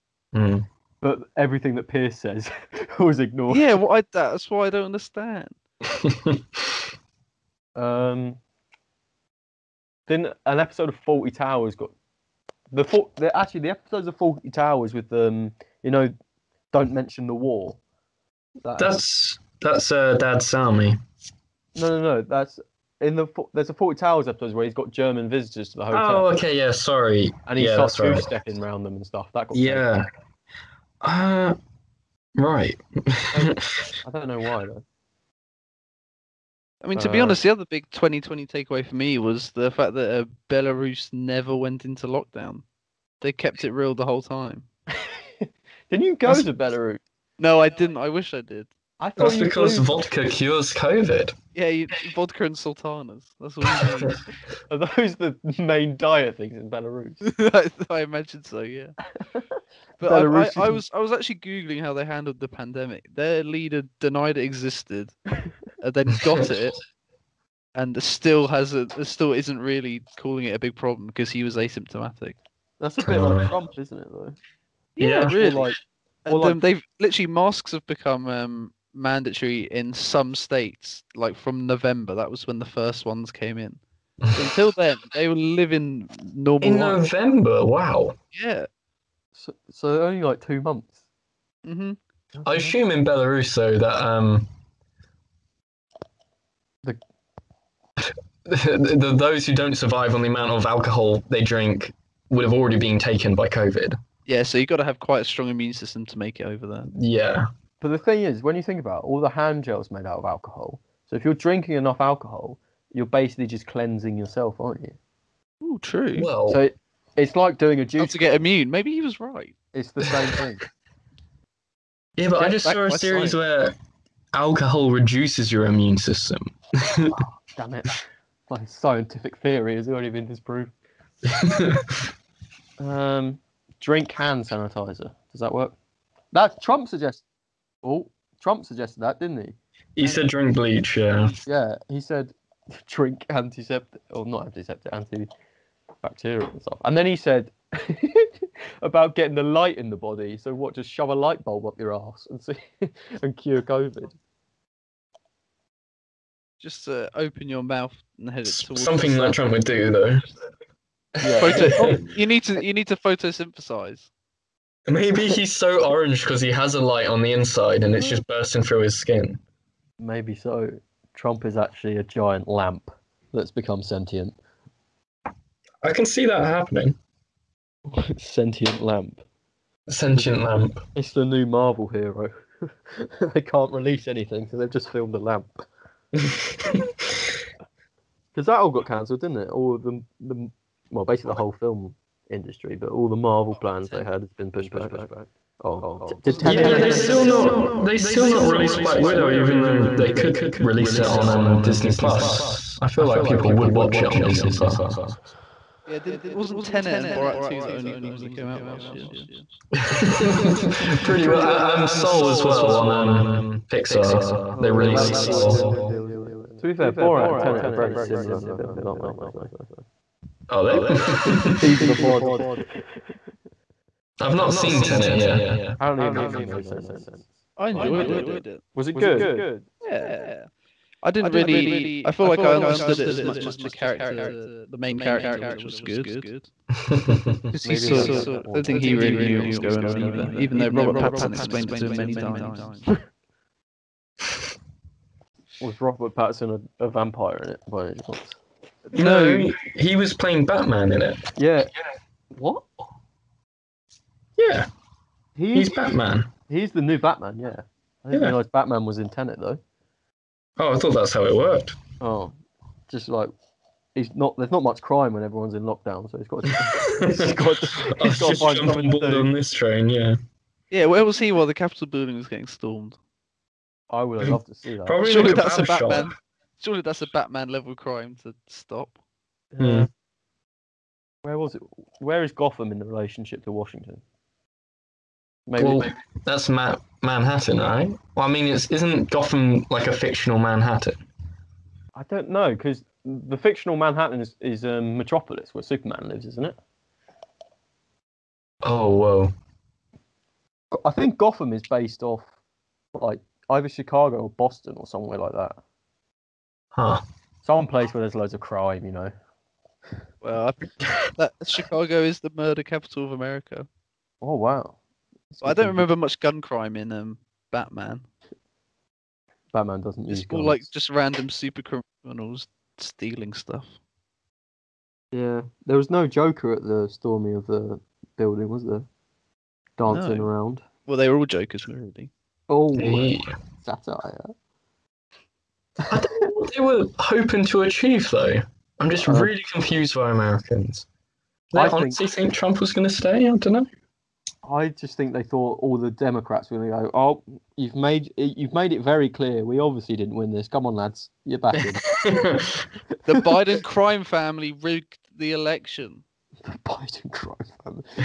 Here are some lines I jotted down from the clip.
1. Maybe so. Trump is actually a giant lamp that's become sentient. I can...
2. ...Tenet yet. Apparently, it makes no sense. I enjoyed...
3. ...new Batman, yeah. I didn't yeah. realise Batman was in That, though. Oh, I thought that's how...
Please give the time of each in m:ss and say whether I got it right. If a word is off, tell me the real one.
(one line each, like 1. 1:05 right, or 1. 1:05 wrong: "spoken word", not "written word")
1. 2:49 right
2. 3:44 right
3. 4:16 wrong: "Tenet", not "That".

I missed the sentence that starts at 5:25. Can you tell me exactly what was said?
Yeah, there was no Joker at the storming of the building, was there?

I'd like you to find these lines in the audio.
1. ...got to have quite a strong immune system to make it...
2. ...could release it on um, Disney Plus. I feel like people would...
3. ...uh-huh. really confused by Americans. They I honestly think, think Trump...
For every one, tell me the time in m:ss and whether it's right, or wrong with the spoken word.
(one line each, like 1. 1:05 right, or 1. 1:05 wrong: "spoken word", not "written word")
1. 1:44 right
2. 3:20 right
3. 5:39 right.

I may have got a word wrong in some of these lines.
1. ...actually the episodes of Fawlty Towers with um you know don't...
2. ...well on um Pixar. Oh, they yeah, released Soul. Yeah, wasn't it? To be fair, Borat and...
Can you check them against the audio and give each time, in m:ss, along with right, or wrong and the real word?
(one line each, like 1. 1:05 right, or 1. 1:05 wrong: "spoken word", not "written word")
1. 0:13 right
2. 3:32 right.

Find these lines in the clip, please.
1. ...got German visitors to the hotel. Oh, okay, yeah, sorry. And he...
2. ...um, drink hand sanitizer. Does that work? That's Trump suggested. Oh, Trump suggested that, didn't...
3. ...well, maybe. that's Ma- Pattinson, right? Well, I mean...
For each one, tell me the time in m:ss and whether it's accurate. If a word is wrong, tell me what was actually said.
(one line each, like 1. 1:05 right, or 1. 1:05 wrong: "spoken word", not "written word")
1. 0:24 right
2. 2:12 right
3. 4:45 wrong: "Manhattan", not "Pattinson".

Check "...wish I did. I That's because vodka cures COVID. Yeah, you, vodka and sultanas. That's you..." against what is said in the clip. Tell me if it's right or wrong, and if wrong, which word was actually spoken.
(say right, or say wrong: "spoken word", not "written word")
right.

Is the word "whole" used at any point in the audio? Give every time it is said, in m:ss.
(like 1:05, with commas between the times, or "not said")
0:44, 3:11.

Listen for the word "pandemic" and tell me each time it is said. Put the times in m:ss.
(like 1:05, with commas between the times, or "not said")
1:02.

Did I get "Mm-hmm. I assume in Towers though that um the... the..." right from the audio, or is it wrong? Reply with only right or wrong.
wrong.